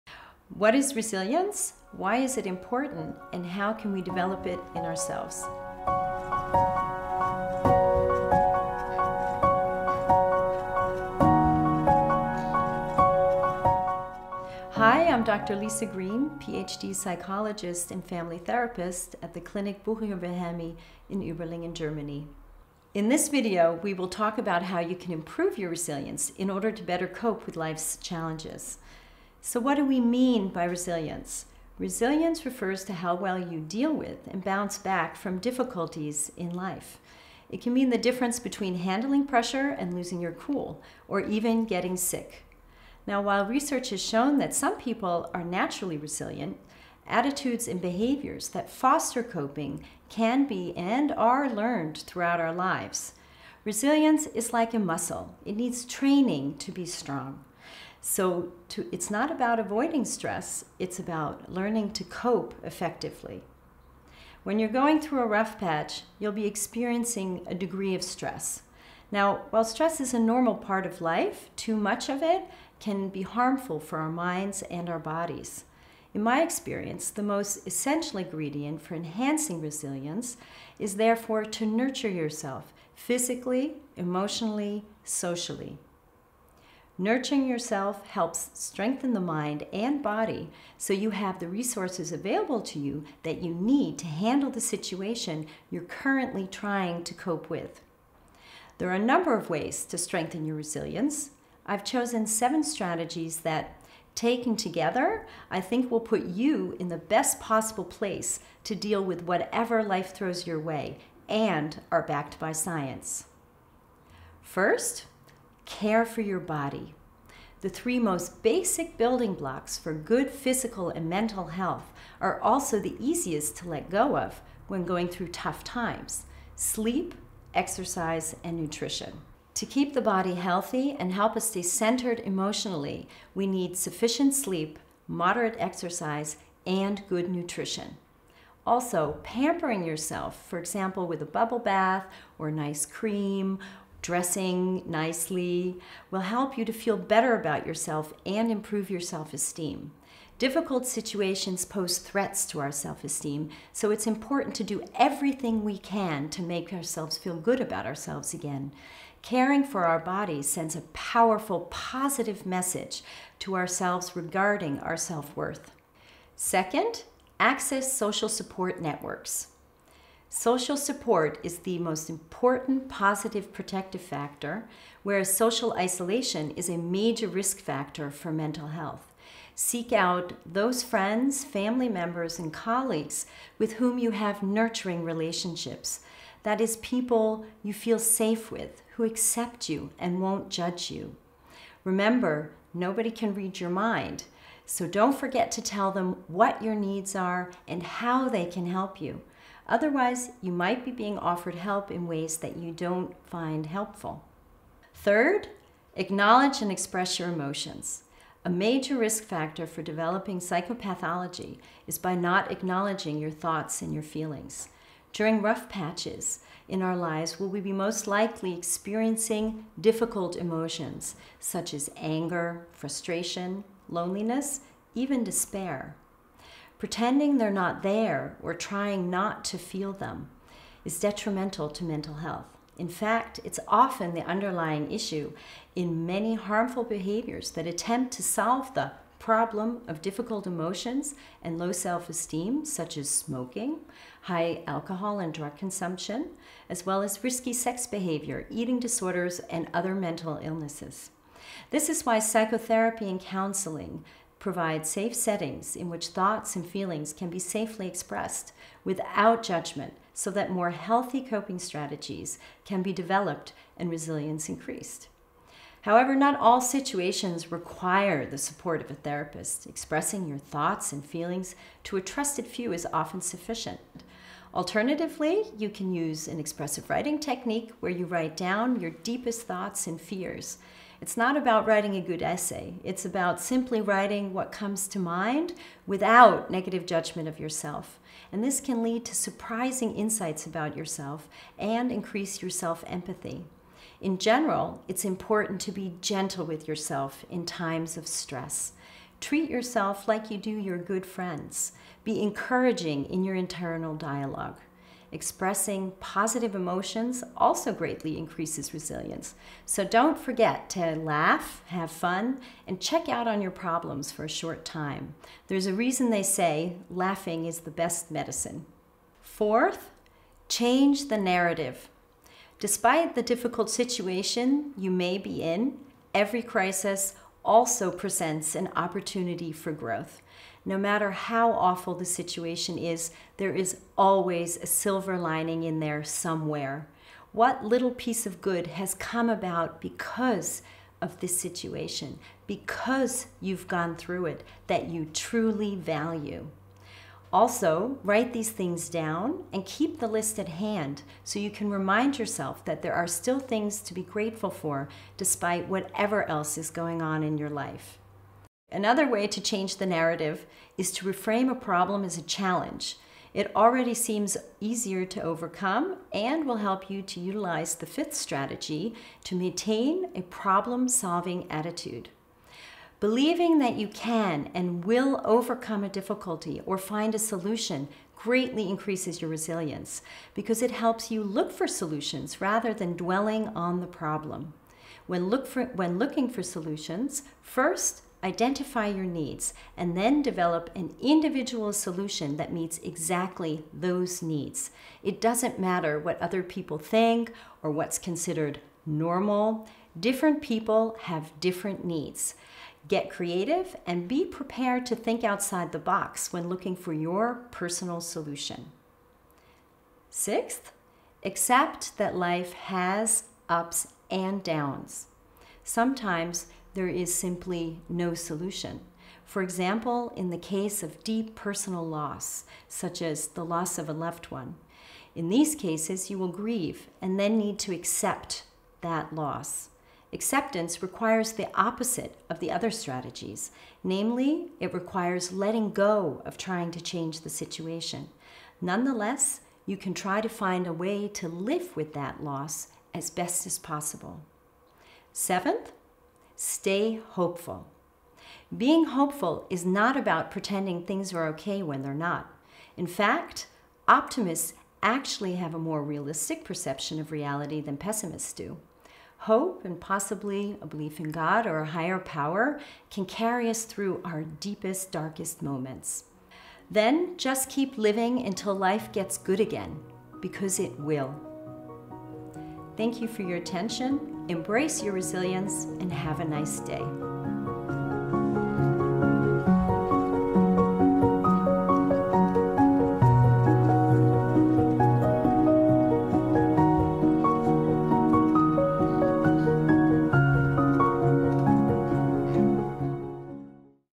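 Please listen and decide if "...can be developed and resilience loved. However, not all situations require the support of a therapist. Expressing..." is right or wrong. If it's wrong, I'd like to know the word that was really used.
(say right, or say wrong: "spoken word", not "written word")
wrong: "increased", not "loved".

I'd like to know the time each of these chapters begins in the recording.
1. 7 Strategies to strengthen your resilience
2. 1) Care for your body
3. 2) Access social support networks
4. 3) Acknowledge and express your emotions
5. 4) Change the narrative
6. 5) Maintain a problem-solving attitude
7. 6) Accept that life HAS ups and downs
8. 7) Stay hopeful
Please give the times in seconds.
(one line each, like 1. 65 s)
1. 98 s
2. 113 s
3. 165 s
4. 204 s
5. 318 s
6. 368 s
7. 409 s
8. 444 s.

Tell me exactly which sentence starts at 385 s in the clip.
When, look for, when looking for solutions, first identify your needs, and then develop an individual solution that meets exactly those needs.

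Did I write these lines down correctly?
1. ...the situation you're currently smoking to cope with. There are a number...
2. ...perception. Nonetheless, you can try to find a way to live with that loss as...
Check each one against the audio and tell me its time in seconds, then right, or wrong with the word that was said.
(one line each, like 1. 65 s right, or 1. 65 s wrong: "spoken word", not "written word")
1. 94 s wrong: "trying", not "smoking"
2. 437 s wrong: "situation", not "perception".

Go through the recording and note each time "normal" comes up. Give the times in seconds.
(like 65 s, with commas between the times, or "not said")
70 s, 398 s.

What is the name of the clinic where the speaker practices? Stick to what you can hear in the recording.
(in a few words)
Clinic Buchinger Wilhelmi.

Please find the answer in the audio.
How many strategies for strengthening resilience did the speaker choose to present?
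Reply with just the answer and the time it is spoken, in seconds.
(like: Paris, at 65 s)
7, at 102 s.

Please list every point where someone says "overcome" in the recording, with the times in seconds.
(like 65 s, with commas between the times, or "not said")
365 s, 375 s.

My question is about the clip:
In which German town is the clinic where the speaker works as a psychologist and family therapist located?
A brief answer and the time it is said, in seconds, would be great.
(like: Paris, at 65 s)
Überlingen, at 21 s.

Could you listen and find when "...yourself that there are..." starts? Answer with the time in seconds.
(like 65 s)
352 s.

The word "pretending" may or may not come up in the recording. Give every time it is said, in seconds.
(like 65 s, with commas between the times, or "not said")
226 s, 450 s.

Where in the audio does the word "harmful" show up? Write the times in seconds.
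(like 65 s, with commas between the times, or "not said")
73 s, 236 s.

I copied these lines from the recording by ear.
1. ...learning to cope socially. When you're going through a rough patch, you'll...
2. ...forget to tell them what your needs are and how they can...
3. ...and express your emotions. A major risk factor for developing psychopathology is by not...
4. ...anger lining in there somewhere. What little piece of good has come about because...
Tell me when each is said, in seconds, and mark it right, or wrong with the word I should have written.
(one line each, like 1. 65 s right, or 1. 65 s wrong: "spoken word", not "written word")
1. 61 s wrong: "effectively", not "socially"
2. 195 s right
3. 206 s right
4. 334 s wrong: "silver", not "anger".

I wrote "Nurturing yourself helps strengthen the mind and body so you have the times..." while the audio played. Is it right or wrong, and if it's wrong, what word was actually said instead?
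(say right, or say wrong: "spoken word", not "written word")
wrong: "resources", not "times".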